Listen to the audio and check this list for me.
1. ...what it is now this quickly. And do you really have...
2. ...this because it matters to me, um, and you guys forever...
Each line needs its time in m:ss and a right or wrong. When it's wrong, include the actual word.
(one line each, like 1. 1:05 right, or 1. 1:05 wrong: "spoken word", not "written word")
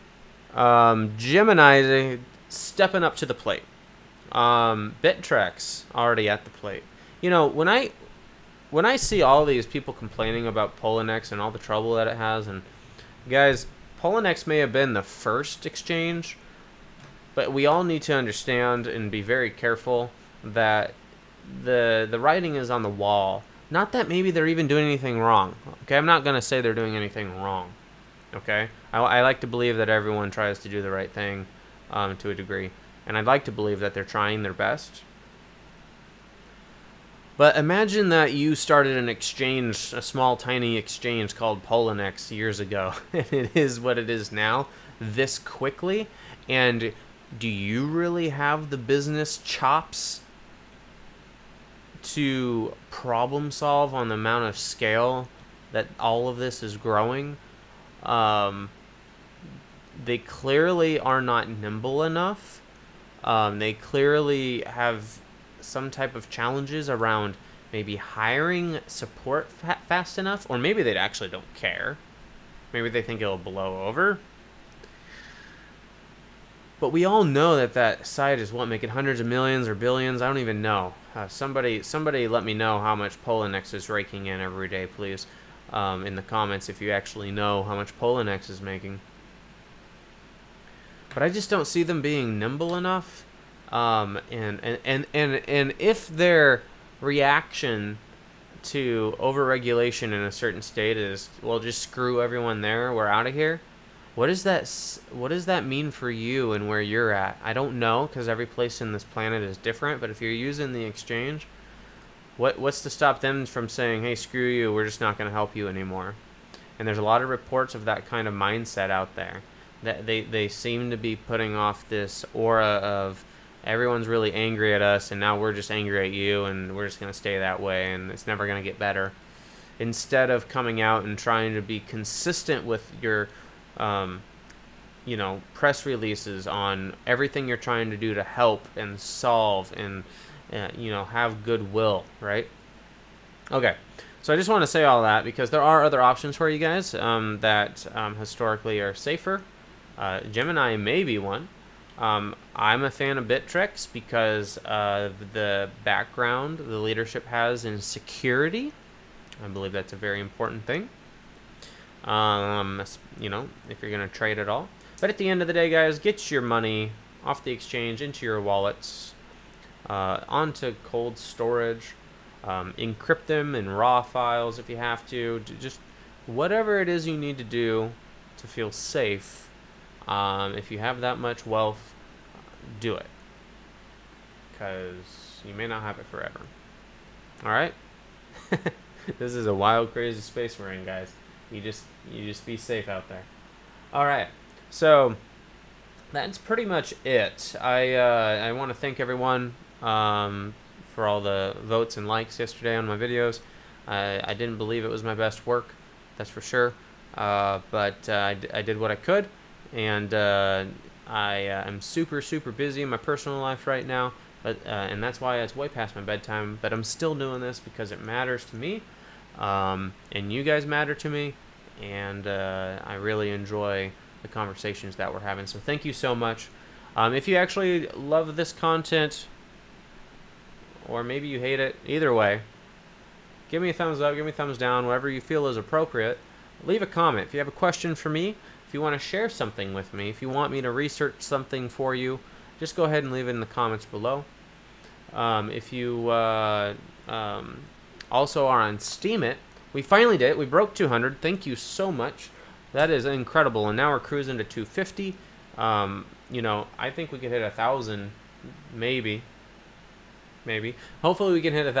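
1. 0:43 right
2. 3:37 wrong: "matter", not "forever".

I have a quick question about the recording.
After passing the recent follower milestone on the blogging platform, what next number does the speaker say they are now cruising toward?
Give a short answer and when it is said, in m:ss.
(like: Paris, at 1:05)
250, at 4:13.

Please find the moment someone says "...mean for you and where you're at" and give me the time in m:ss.
1:45.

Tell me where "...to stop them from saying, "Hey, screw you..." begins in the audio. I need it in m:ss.
1:52.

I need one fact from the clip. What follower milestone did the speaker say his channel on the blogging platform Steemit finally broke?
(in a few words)
200.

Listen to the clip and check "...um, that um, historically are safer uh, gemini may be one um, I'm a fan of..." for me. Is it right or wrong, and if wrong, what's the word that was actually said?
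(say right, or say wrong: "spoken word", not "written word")
right.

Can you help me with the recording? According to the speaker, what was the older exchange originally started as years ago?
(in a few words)
a small tiny exchange.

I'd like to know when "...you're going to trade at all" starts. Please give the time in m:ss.
2:43.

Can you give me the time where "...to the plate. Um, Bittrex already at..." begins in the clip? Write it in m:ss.
0:03.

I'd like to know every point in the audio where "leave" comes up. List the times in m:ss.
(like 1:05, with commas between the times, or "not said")
3:56, 4:03.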